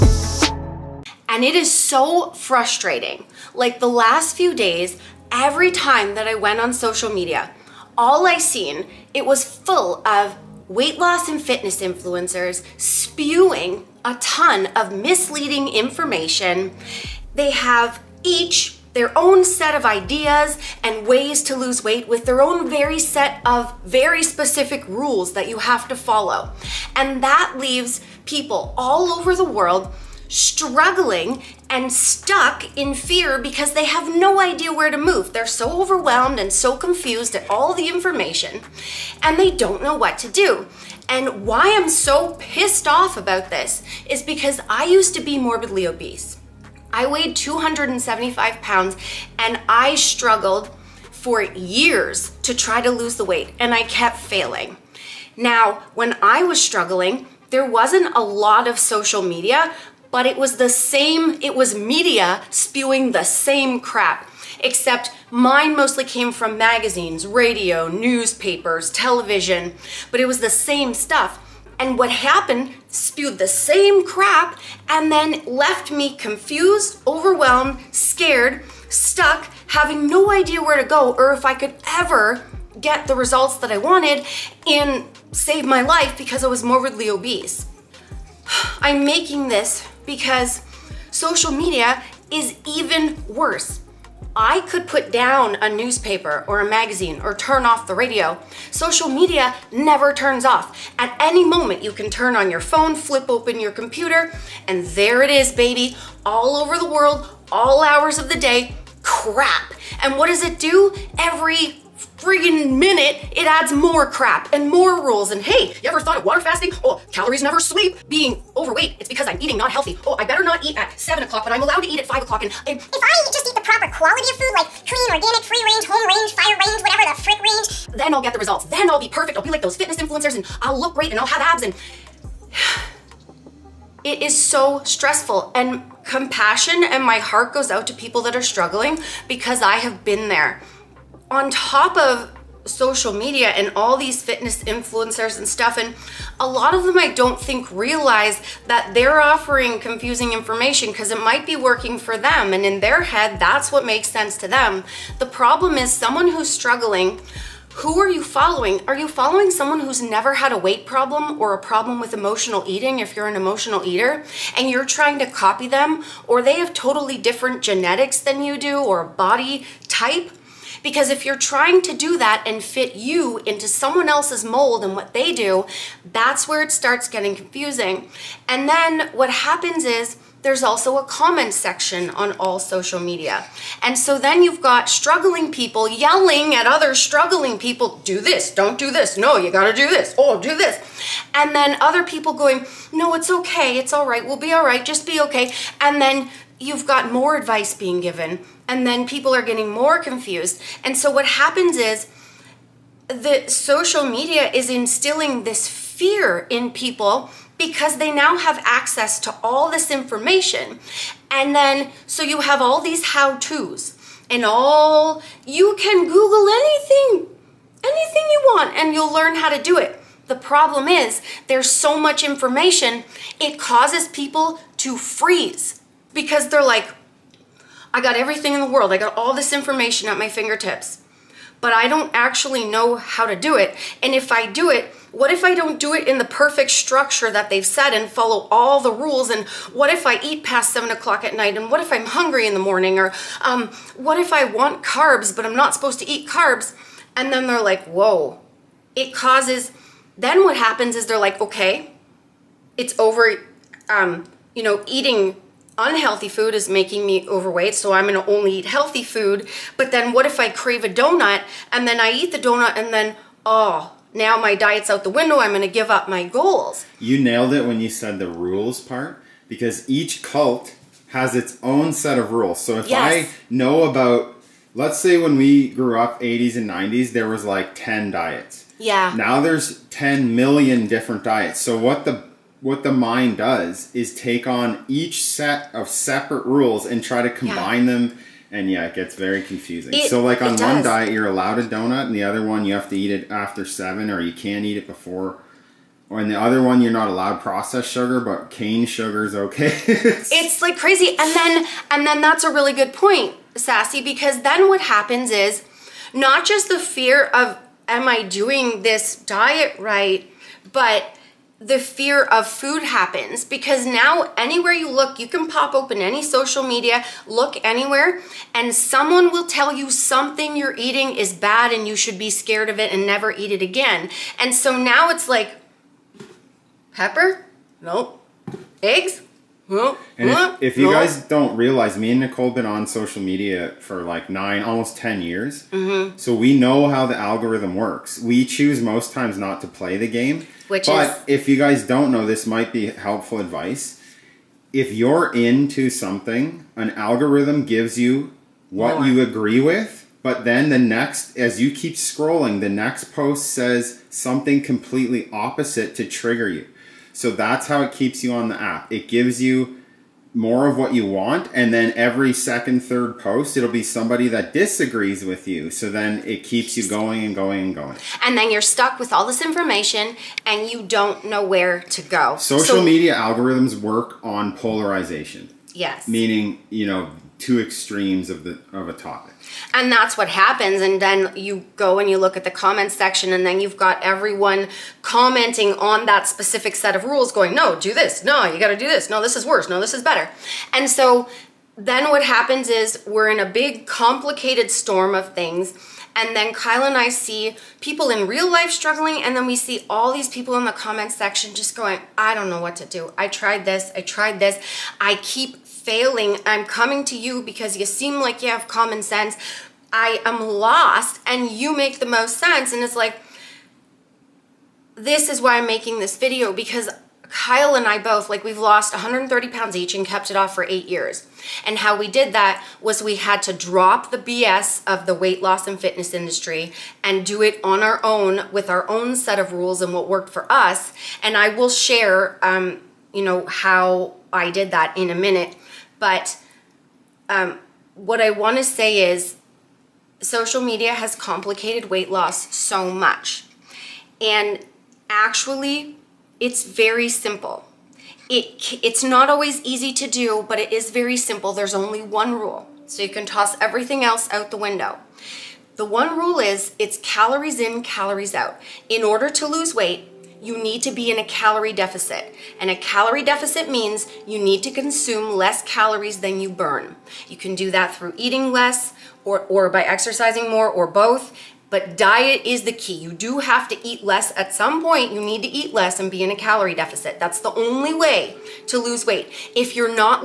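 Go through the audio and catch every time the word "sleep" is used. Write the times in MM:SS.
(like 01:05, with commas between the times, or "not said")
01:57.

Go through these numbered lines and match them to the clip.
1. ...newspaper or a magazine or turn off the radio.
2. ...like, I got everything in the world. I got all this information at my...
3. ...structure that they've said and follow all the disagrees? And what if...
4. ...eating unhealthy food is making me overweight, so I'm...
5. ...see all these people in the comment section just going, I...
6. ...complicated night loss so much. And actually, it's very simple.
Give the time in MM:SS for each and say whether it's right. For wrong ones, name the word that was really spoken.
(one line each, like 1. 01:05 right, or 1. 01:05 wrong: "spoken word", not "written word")
1. 01:35 right
2. 03:46 right
3. 03:56 wrong: "rules", not "disagrees"
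4. 04:14 right
5. 06:39 right
6. 07:21 wrong: "weight", not "night".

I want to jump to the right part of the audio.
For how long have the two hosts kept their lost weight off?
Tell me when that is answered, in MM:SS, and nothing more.
07:00.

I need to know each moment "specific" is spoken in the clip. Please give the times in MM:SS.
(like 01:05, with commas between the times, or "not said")
00:24, 06:26.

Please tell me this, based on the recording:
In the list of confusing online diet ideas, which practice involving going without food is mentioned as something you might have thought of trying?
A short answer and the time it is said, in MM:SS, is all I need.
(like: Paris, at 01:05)
water fasting, at 01:56.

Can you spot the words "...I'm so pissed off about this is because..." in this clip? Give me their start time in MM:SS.
00:41.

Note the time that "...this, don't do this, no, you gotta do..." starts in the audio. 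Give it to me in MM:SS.
03:08.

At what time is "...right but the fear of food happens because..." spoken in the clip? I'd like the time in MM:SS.
05:09.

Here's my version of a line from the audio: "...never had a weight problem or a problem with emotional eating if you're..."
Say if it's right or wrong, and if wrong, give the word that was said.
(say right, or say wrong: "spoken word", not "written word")
right.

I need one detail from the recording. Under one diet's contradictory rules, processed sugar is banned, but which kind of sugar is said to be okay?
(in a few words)
cane sugar.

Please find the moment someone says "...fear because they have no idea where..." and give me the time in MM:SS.
00:32.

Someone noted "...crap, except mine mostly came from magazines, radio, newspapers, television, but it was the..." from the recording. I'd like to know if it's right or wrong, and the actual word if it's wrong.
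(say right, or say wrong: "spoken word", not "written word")
right.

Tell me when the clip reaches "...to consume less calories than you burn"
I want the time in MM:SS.
07:44.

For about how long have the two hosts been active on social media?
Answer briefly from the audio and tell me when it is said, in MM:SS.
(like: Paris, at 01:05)
9, almost 10 years, at 05:34.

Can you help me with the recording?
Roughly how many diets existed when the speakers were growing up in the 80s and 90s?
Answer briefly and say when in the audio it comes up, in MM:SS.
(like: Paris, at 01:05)
10, at 04:37.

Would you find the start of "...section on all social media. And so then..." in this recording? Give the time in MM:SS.
03:01.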